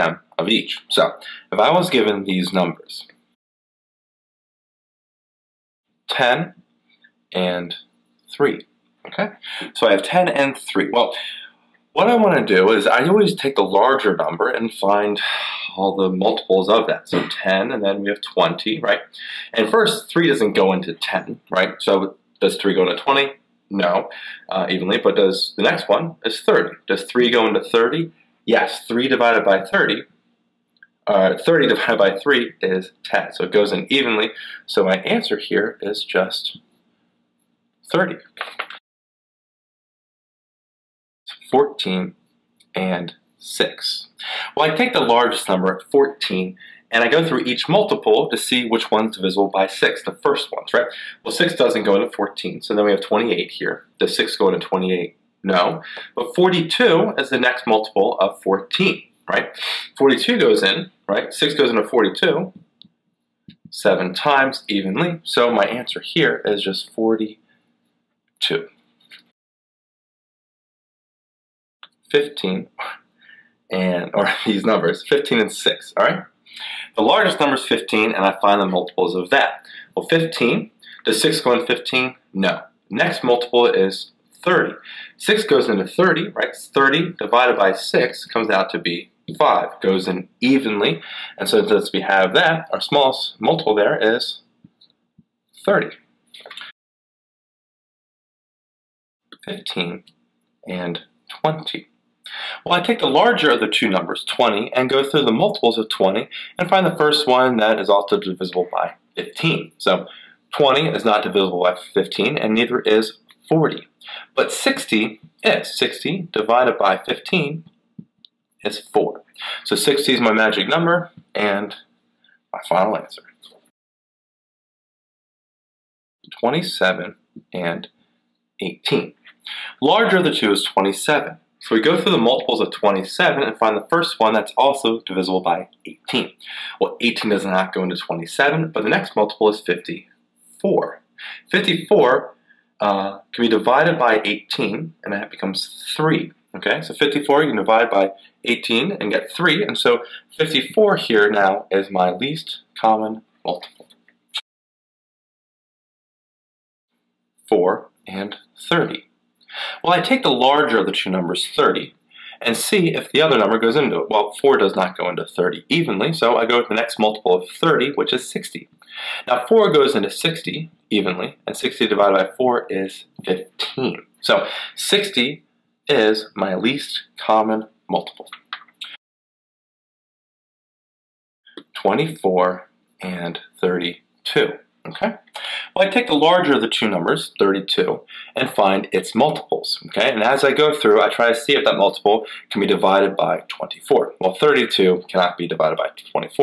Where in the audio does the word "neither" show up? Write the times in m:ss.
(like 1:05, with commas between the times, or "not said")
1:52.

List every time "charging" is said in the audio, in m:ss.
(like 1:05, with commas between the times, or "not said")
not said.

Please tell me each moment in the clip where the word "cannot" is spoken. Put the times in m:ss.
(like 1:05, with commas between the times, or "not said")
3:15.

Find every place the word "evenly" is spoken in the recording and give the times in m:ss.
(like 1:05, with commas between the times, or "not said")
0:24, 0:33, 1:04, 1:30, 2:45, 2:50.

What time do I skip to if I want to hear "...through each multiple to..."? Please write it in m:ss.
0:47.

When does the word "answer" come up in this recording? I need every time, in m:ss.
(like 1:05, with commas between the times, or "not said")
0:35, 1:05, 2:02.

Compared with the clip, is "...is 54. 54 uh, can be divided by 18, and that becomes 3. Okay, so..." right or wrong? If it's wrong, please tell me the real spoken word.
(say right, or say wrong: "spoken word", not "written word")
right.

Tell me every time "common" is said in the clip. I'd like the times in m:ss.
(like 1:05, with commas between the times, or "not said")
2:32, 2:57.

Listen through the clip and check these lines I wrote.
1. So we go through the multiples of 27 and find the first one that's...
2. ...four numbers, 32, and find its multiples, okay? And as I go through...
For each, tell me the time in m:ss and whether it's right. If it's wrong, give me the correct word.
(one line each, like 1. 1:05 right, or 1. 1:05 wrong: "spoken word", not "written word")
1. 2:11 right
2. 3:06 wrong: "two", not "four".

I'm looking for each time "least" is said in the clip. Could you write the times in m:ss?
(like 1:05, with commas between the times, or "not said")
2:32, 2:56.